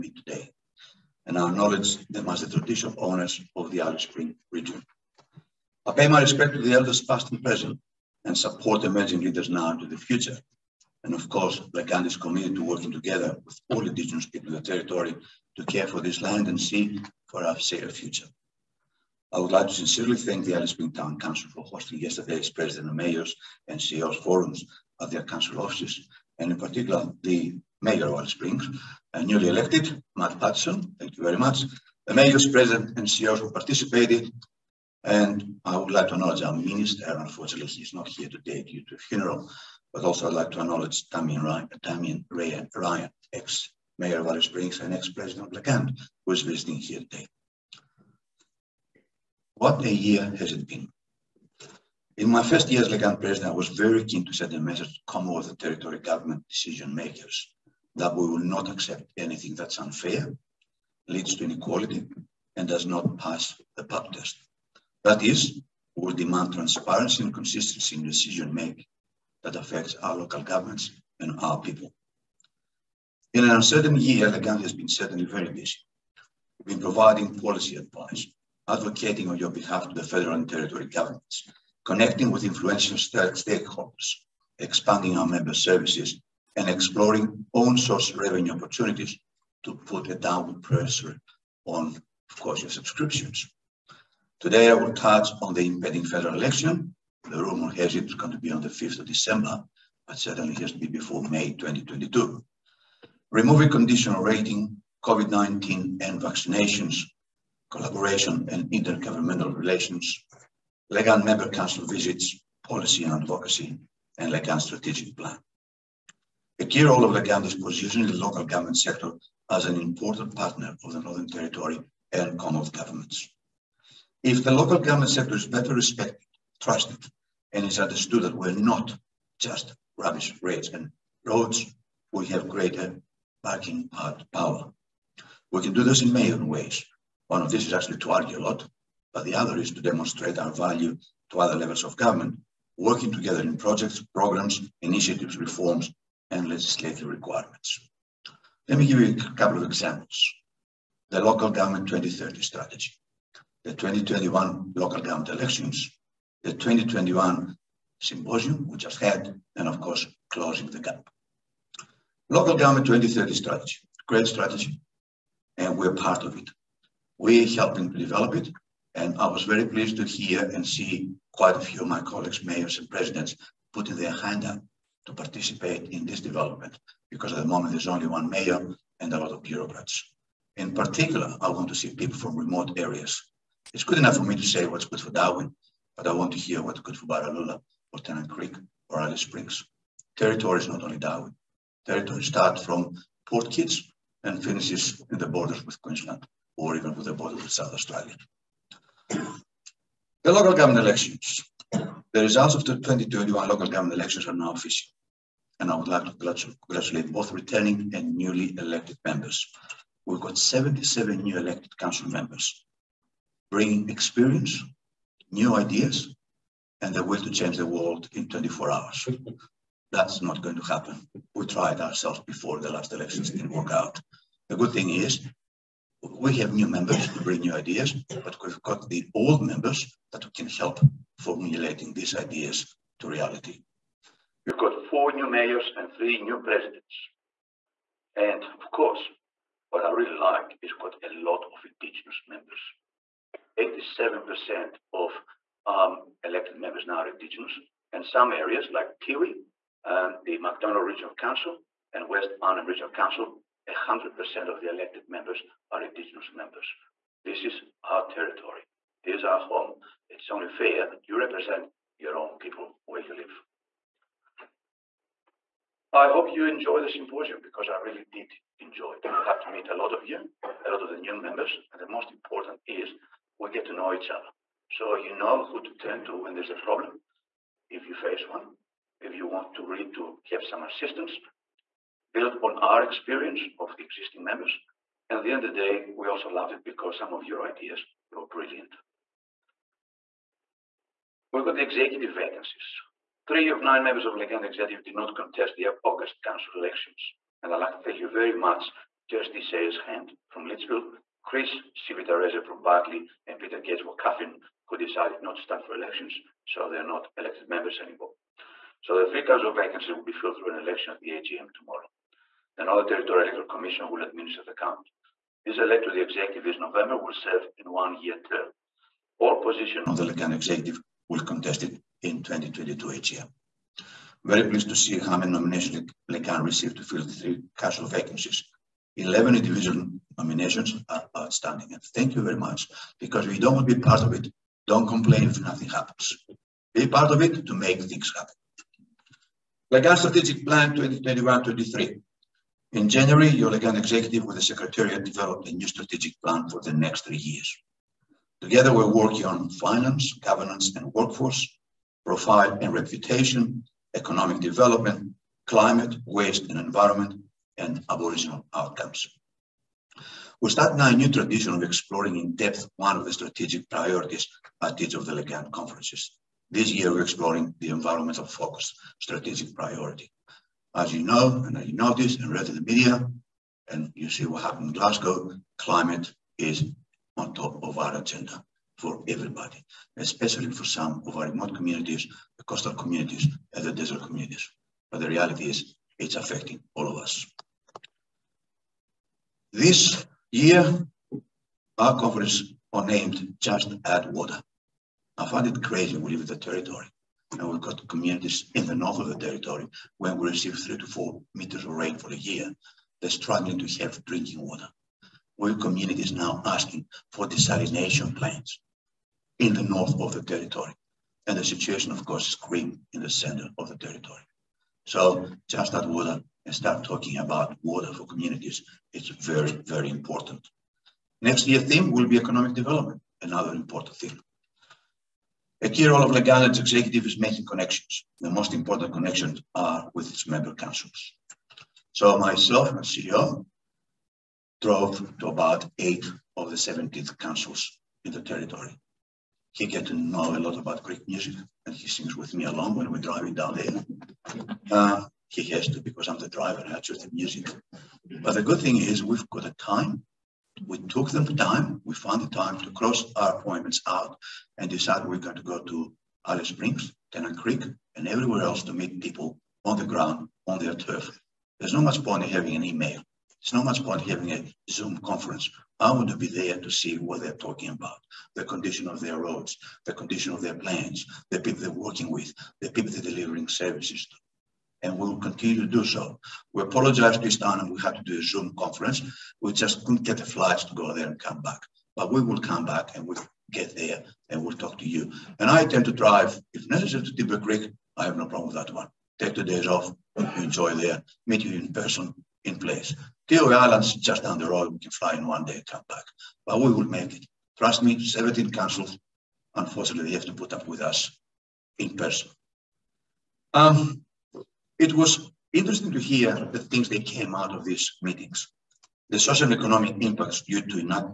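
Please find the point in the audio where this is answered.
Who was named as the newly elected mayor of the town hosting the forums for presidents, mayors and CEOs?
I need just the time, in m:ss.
0:30.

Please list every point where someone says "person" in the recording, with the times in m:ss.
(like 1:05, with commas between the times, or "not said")
8:11, 8:21.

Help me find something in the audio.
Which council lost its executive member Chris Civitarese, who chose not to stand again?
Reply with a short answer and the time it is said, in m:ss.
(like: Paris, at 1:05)
Barkly, at 5:02.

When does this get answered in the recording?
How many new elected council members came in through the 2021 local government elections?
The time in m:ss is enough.
3:30.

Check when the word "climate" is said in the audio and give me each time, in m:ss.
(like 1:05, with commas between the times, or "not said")
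5:55, 6:15.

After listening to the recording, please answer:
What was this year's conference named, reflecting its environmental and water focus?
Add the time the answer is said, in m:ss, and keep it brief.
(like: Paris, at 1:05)
Just Add Water, at 6:33.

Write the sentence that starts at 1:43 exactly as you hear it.
Removing conditional rating, COVID-19 and vaccinations collaboration and intergovernmental relations, LGANT Member Council visits, policy and advocacy, and LGANT strategic plan.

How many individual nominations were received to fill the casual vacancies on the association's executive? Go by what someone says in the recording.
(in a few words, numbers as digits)
11.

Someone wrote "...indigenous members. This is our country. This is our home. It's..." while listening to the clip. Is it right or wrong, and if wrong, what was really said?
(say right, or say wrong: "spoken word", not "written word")
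wrong: "territory", not "country".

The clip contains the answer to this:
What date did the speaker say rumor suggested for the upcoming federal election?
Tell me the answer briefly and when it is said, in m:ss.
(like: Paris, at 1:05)
5th of December, at 1:38.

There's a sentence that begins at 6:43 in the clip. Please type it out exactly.
They're struggling to have drinking water.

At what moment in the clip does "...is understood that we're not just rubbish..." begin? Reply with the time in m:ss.
2:07.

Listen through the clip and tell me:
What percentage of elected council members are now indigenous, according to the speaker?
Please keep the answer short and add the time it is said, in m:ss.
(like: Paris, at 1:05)
87%, at 4:03.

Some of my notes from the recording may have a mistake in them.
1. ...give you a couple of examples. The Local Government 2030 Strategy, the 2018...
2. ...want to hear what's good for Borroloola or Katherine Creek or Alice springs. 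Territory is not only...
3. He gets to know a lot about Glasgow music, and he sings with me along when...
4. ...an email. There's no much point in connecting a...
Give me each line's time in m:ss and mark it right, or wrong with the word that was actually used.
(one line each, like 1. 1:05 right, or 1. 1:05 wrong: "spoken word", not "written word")
1. 2:28 wrong: "2021", not "2018"
2. 3:06 wrong: "Tennant", not "Katherine"
3. 7:19 wrong: "Greek", not "Glasgow"
4. 7:42 wrong: "having", not "connecting".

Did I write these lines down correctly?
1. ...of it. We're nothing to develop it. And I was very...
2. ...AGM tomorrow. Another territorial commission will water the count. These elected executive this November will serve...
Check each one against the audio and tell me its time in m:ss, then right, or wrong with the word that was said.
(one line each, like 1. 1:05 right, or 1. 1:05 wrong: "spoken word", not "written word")
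1. 2:46 wrong: "helping", not "nothing"
2. 5:11 wrong: "administer", not "water".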